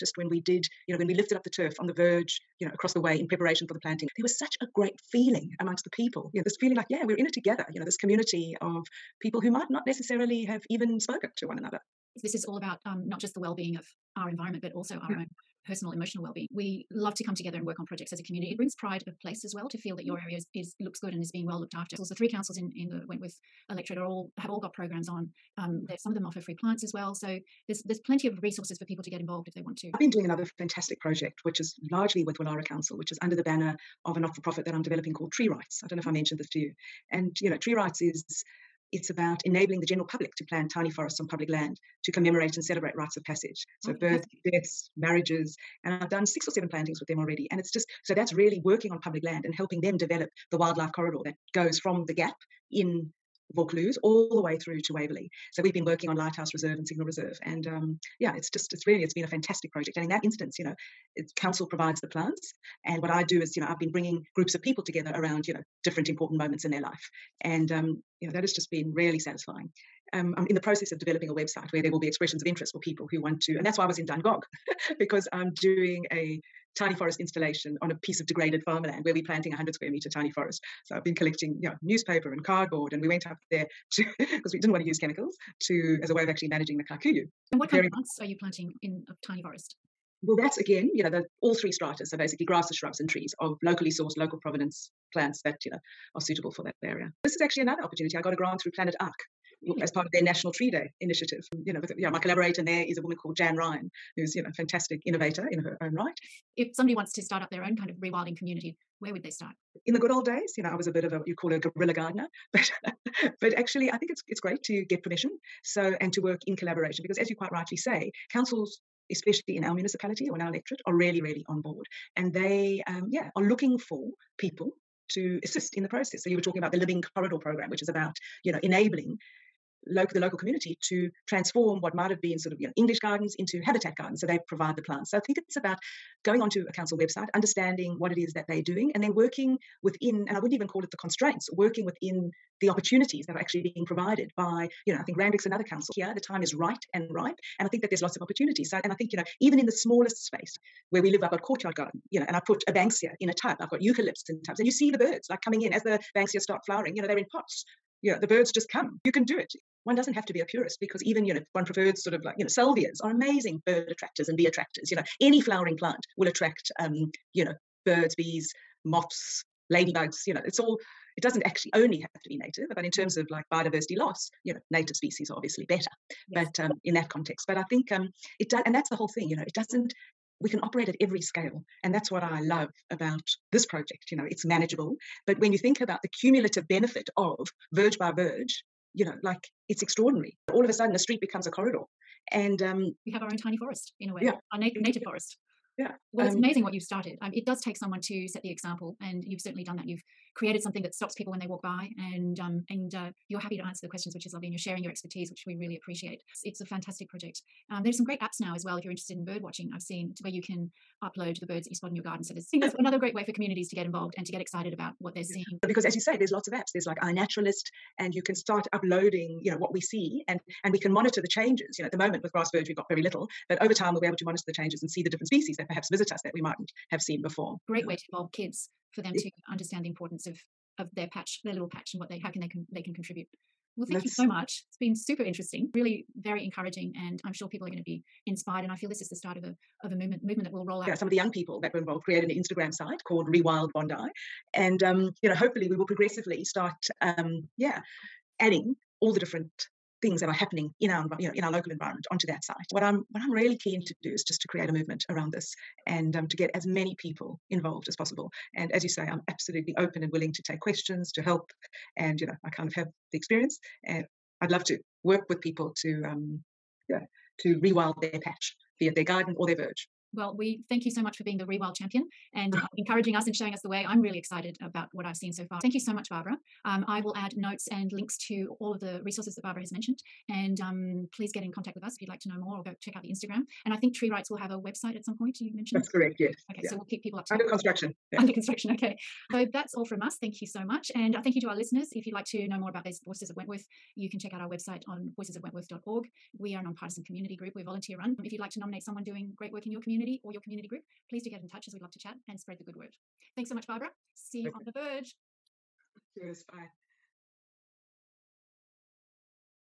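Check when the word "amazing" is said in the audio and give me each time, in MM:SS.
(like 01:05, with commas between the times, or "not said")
02:43, 03:16.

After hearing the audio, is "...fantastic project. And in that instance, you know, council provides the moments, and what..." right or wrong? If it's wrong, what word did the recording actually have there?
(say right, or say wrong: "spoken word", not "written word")
wrong: "plants", not "moments".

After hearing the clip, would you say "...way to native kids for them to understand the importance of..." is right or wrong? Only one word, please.
wrong.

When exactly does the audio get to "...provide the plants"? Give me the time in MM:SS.
02:14.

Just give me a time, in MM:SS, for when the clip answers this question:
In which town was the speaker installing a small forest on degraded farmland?
01:14.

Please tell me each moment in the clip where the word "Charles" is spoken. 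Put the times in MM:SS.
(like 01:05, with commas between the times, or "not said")
not said.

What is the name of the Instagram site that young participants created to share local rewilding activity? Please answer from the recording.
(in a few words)
Rewild Bondi.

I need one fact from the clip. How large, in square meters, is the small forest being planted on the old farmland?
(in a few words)
100.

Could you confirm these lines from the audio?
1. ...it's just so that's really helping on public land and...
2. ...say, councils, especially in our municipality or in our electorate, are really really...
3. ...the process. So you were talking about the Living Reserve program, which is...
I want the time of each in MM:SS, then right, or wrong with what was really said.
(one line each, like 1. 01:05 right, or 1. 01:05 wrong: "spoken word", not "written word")
1. 00:47 wrong: "working", not "helping"
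2. 01:57 right
3. 02:05 wrong: "Corridor", not "Reserve".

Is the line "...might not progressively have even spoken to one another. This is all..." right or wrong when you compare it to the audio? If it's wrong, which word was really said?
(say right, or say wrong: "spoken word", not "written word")
wrong: "necessarily", not "progressively".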